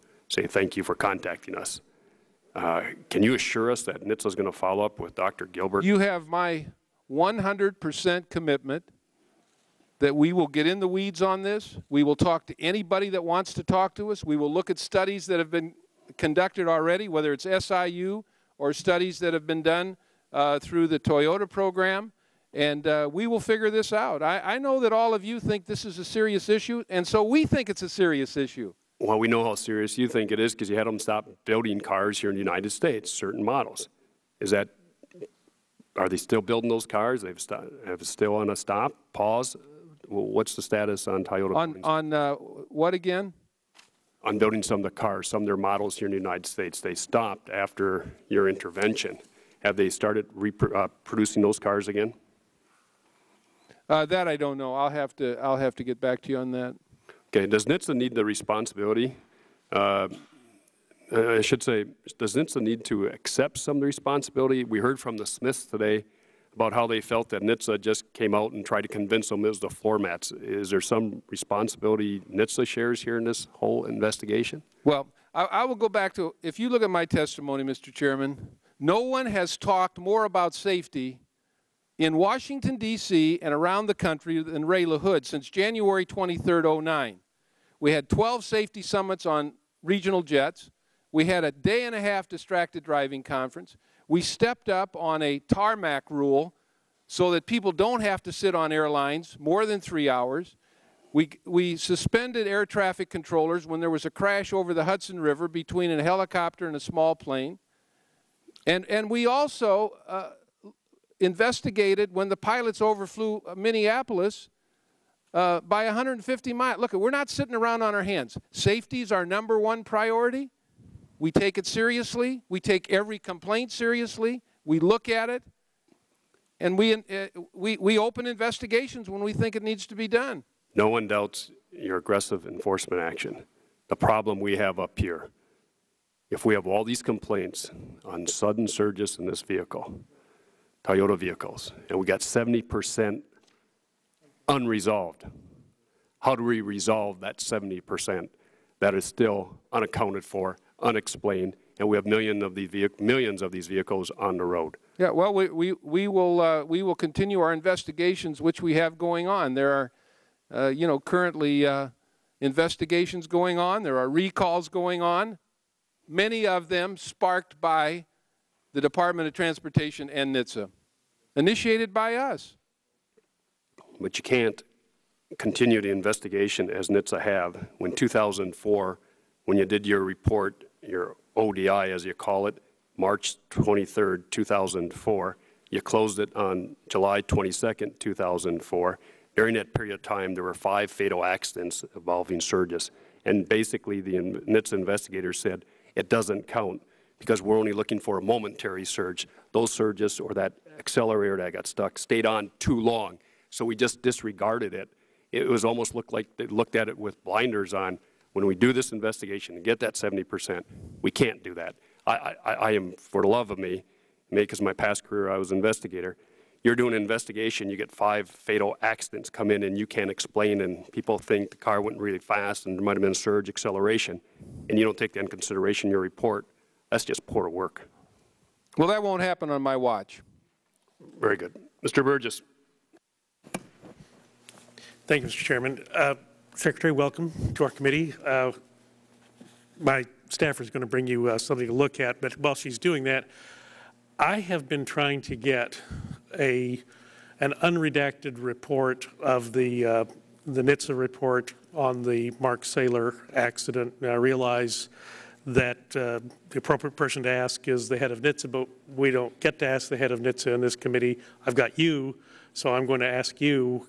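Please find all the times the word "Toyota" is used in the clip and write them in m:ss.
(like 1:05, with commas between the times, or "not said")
0:20, 0:41, 2:20.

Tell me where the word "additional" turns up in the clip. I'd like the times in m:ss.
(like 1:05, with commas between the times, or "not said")
not said.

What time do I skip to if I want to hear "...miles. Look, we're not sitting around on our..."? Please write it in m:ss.
1:56.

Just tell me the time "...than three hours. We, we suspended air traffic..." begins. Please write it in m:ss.
1:39.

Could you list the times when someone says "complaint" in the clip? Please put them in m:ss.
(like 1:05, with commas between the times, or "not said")
2:03, 2:17.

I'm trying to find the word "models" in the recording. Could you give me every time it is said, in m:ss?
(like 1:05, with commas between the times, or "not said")
0:33, 0:45.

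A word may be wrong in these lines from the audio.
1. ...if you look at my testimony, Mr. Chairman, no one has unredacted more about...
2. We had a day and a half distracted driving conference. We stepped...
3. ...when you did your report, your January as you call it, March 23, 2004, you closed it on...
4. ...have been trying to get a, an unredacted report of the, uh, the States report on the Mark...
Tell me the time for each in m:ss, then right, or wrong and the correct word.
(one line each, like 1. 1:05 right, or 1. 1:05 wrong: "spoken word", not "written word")
1. 1:16 wrong: "talked", not "unredacted"
2. 1:31 right
3. 2:59 wrong: "ODI", not "January"
4. 4:04 wrong: "NHTSA", not "States".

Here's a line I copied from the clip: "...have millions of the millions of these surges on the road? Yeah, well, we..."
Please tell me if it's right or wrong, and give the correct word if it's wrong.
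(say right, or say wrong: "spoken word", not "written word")
wrong: "vehicles", not "surges".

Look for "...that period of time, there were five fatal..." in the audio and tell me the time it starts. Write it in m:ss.
3:09.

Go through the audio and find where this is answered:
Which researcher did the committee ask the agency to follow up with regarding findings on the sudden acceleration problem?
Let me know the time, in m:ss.
0:05.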